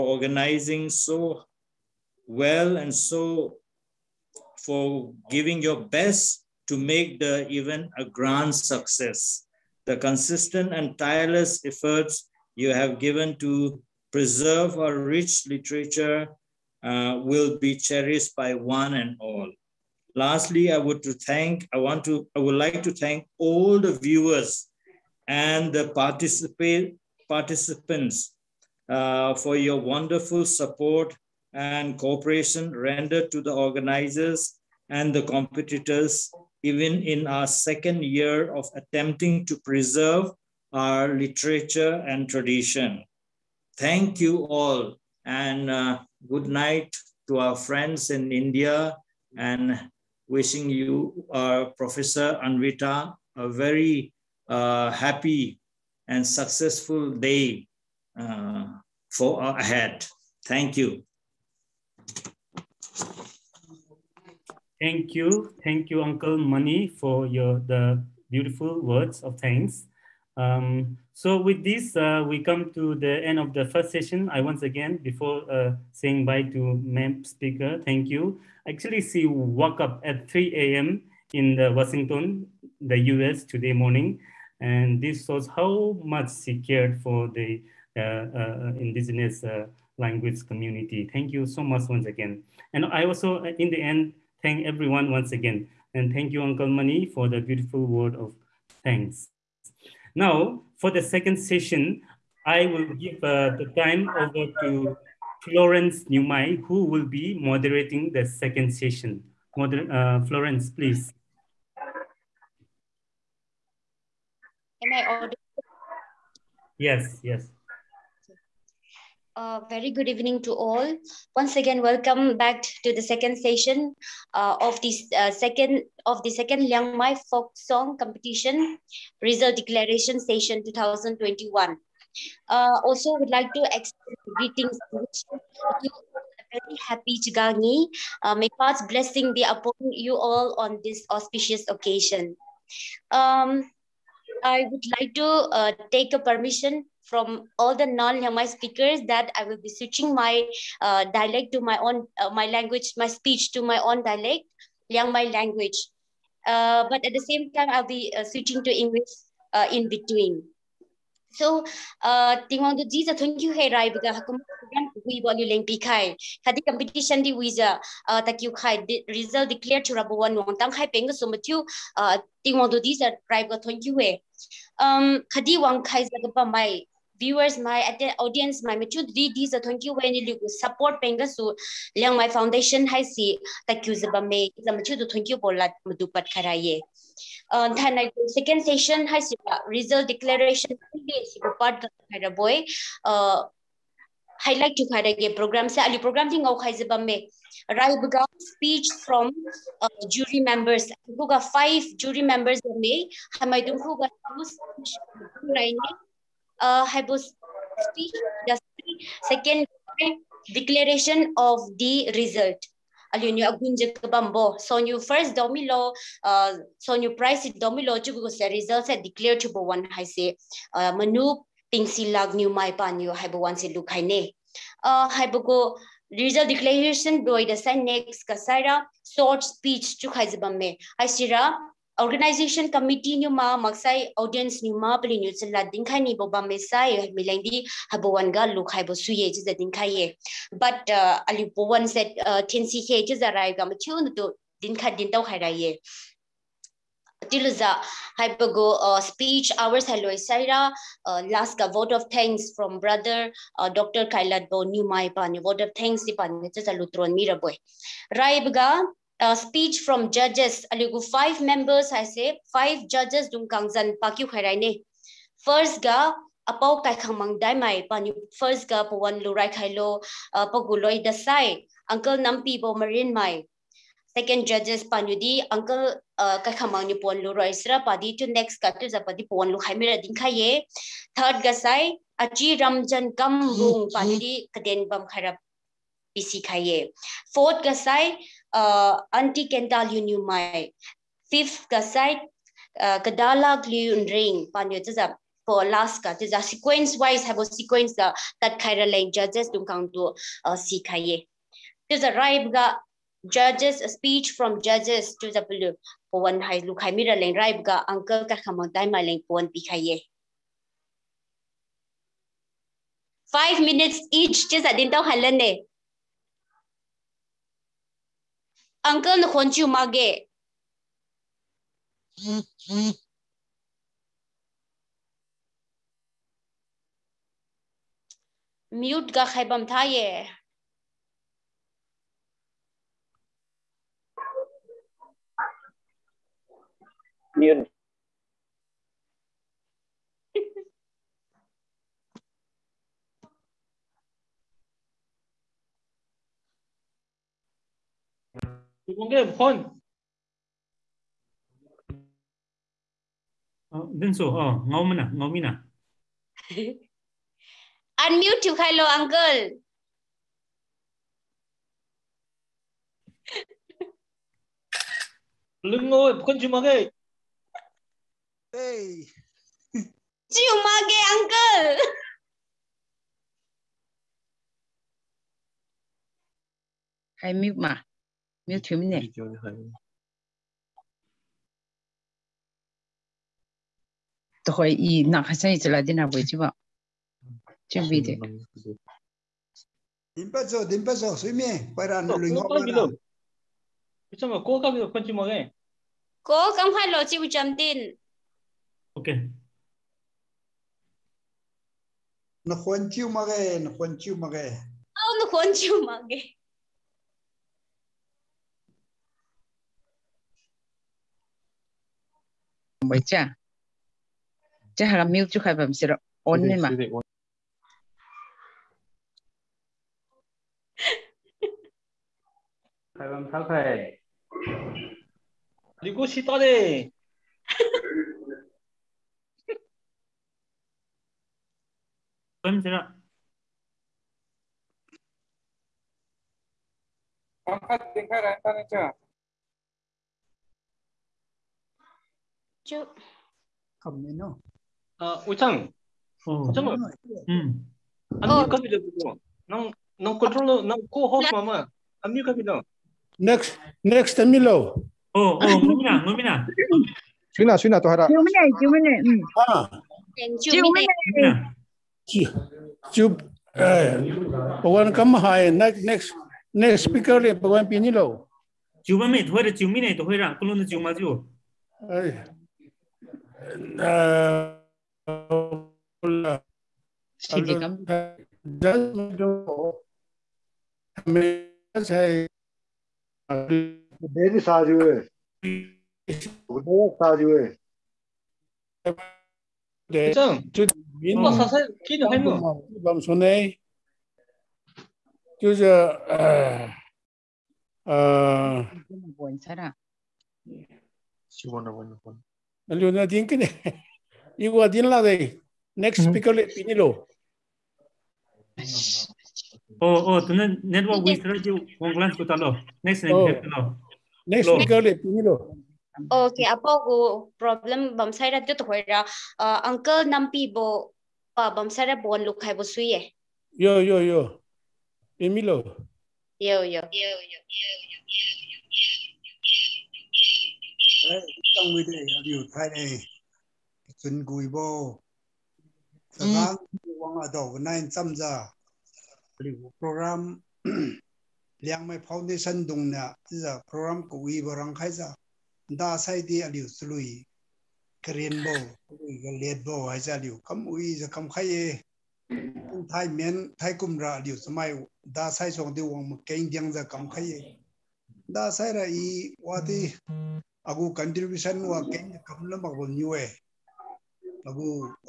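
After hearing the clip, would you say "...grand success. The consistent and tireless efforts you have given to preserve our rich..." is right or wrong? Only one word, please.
right.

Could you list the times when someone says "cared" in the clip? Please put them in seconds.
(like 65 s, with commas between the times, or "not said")
86 s.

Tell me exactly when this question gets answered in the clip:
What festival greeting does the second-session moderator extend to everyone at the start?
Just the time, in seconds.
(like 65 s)
137 s.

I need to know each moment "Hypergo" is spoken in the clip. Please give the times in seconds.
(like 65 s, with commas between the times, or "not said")
248 s.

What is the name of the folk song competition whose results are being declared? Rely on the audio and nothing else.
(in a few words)
Liangmai folk song competition.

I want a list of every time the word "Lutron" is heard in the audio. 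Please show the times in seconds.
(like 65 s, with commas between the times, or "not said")
256 s.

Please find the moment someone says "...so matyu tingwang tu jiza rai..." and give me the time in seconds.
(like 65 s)
171 s.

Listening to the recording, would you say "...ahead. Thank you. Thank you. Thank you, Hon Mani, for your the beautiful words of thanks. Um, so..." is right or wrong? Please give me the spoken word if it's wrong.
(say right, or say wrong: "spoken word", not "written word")
wrong: "Uncle", not "Hon".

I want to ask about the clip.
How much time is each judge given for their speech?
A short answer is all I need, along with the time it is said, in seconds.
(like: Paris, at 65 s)
Five minutes, at 313 s.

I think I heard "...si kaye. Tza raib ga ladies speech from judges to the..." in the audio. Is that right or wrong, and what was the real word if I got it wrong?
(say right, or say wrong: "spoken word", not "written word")
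wrong: "judges", not "ladies".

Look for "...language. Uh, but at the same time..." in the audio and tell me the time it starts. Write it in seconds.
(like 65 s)
155 s.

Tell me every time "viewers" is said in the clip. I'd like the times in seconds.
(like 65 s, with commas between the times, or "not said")
23 s, 177 s.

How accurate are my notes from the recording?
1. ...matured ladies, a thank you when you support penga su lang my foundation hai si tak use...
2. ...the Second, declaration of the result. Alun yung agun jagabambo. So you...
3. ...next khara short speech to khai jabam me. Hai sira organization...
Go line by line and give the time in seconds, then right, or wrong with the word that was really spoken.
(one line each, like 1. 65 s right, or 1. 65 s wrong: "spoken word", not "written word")
1. 178 s right
2. 208 s right
3. 227 s wrong: "kasara", not "khara".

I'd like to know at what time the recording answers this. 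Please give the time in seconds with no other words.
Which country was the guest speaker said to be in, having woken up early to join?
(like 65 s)
82 s.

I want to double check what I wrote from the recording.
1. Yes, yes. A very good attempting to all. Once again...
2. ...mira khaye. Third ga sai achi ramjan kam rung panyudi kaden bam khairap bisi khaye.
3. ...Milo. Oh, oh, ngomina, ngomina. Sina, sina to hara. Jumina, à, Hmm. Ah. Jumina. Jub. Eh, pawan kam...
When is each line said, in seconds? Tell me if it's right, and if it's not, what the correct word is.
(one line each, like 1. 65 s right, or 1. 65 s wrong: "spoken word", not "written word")
1. 116 s wrong: "evening", not "attempting"
2. 279 s right
3. 454 s right.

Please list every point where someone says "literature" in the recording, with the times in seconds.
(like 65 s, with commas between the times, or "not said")
15 s, 41 s.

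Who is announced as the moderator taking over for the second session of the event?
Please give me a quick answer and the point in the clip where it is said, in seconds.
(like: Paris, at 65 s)
Florence Newmai, at 105 s.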